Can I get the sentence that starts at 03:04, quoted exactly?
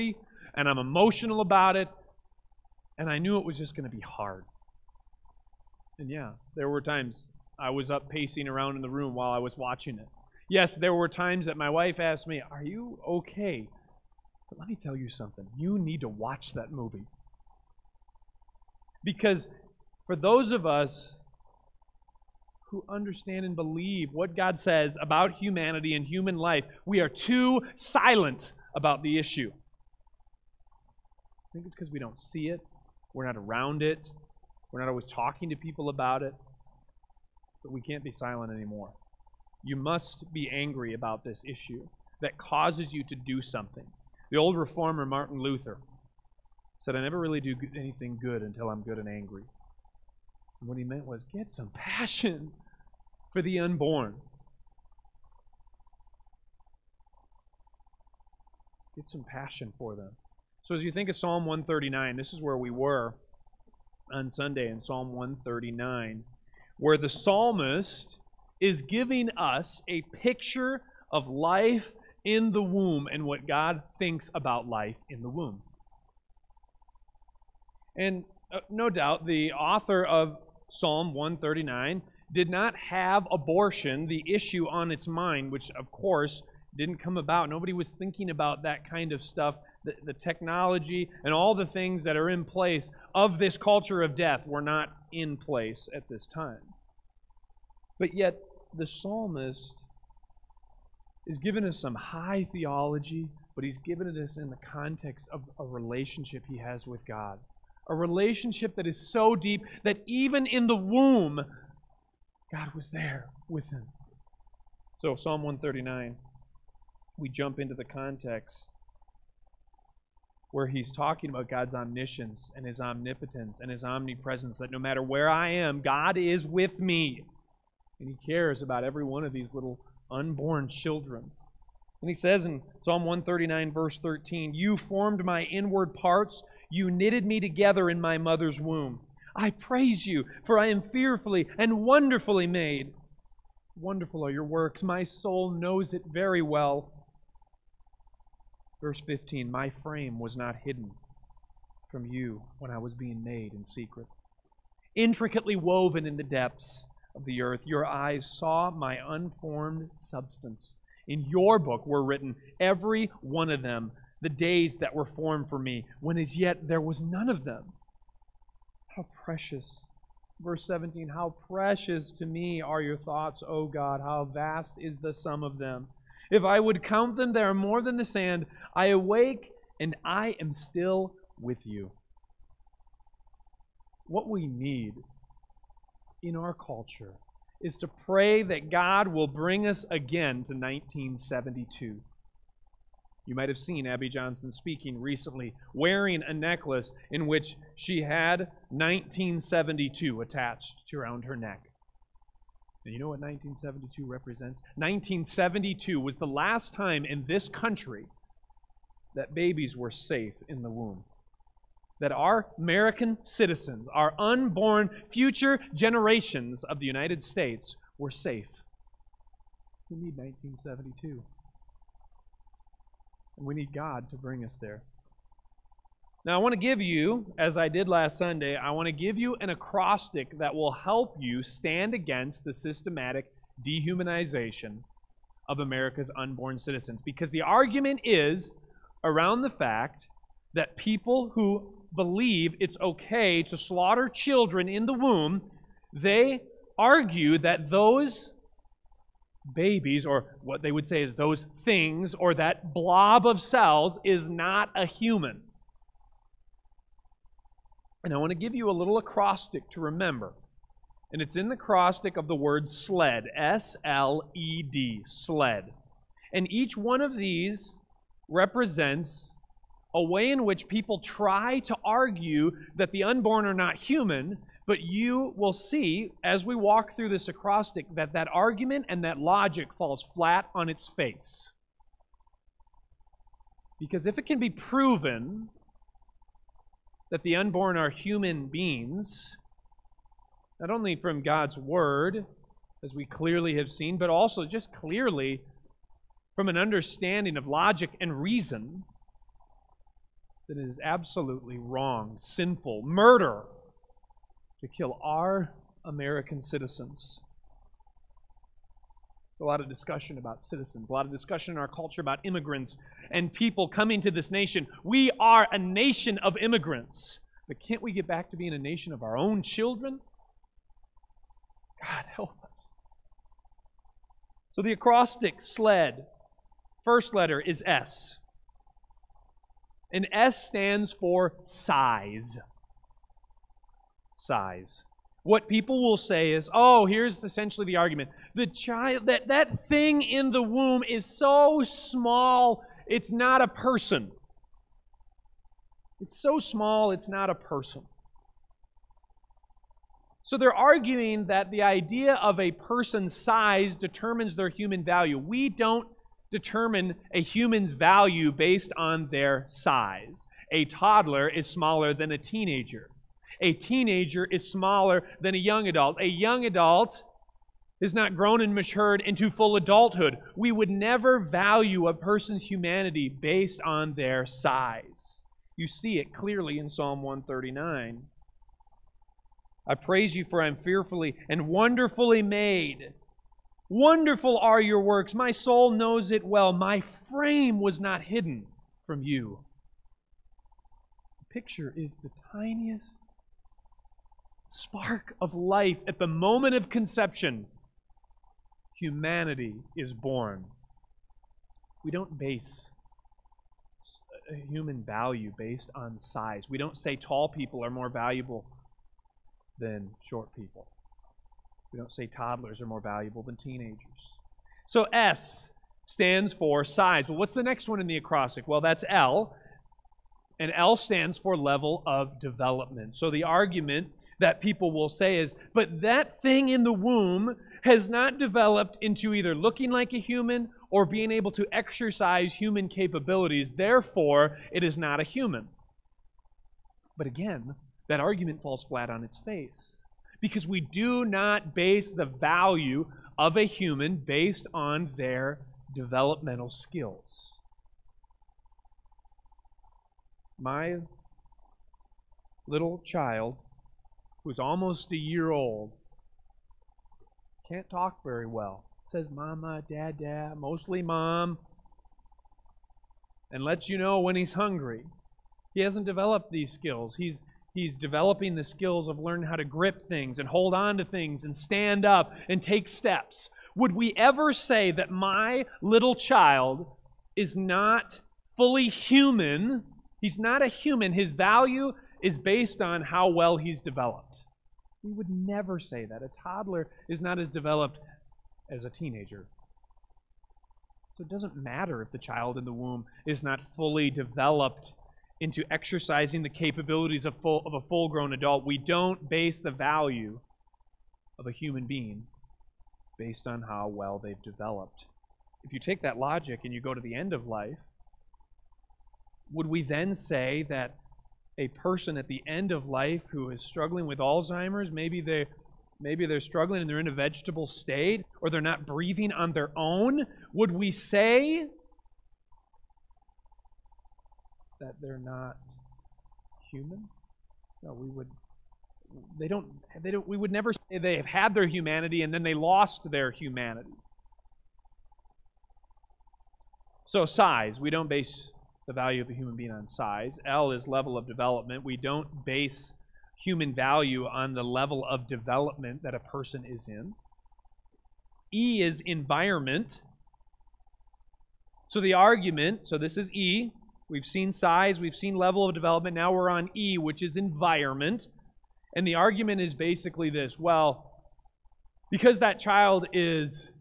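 What we need in our culture is to pray that God will bring us again to 1972.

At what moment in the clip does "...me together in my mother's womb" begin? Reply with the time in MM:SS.
02:17.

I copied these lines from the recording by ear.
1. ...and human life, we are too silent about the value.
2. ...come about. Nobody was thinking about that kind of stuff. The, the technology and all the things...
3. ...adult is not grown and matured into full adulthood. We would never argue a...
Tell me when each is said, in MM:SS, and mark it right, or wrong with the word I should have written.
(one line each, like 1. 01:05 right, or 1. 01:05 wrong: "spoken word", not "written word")
1. 00:25 wrong: "issue", not "value"
2. 01:26 right
3. 06:06 wrong: "value", not "argue".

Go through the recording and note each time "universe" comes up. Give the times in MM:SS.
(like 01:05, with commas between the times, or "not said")
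not said.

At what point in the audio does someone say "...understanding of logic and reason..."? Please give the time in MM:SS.
04:56.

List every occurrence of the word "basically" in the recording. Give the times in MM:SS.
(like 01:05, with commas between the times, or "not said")
09:19.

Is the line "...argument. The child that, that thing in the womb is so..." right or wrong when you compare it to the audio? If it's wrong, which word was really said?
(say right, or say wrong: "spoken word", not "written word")
right.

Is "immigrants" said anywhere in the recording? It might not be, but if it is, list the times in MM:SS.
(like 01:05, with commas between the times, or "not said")
05:12, 05:16.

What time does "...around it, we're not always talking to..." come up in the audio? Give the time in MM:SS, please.
00:33.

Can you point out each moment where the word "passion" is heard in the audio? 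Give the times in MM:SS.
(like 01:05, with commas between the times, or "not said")
00:51, 00:59.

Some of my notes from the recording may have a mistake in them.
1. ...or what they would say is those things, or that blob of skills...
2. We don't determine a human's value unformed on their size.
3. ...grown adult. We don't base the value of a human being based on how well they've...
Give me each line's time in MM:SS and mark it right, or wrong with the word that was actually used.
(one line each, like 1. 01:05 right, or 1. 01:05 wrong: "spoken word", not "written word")
1. 04:10 wrong: "cells", not "skills"
2. 05:55 wrong: "based", not "unformed"
3. 08:17 right.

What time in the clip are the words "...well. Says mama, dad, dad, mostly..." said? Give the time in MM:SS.
07:38.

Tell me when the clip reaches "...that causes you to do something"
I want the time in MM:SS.
00:42.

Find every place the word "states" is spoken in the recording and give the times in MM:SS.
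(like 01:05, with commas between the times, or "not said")
03:37, 08:37.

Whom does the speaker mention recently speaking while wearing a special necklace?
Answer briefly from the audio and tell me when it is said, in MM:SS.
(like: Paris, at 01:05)
Abby Johnson, at 03:13.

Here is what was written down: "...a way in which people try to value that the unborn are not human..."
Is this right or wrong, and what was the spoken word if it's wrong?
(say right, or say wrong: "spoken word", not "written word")
wrong: "argue", not "value".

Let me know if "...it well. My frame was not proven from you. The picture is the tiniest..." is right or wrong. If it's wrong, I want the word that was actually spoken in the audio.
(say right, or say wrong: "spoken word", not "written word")
wrong: "hidden", not "proven".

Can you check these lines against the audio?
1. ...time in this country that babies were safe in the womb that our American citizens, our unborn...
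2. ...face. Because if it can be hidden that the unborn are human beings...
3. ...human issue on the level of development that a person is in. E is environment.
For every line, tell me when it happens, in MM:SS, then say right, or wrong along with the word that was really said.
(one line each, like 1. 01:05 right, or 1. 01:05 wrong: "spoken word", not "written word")
1. 03:26 right
2. 04:40 wrong: "proven", not "hidden"
3. 09:03 wrong: "value", not "issue".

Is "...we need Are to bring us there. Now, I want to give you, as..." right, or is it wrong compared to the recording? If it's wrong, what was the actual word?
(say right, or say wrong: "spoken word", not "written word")
wrong: "God", not "Are".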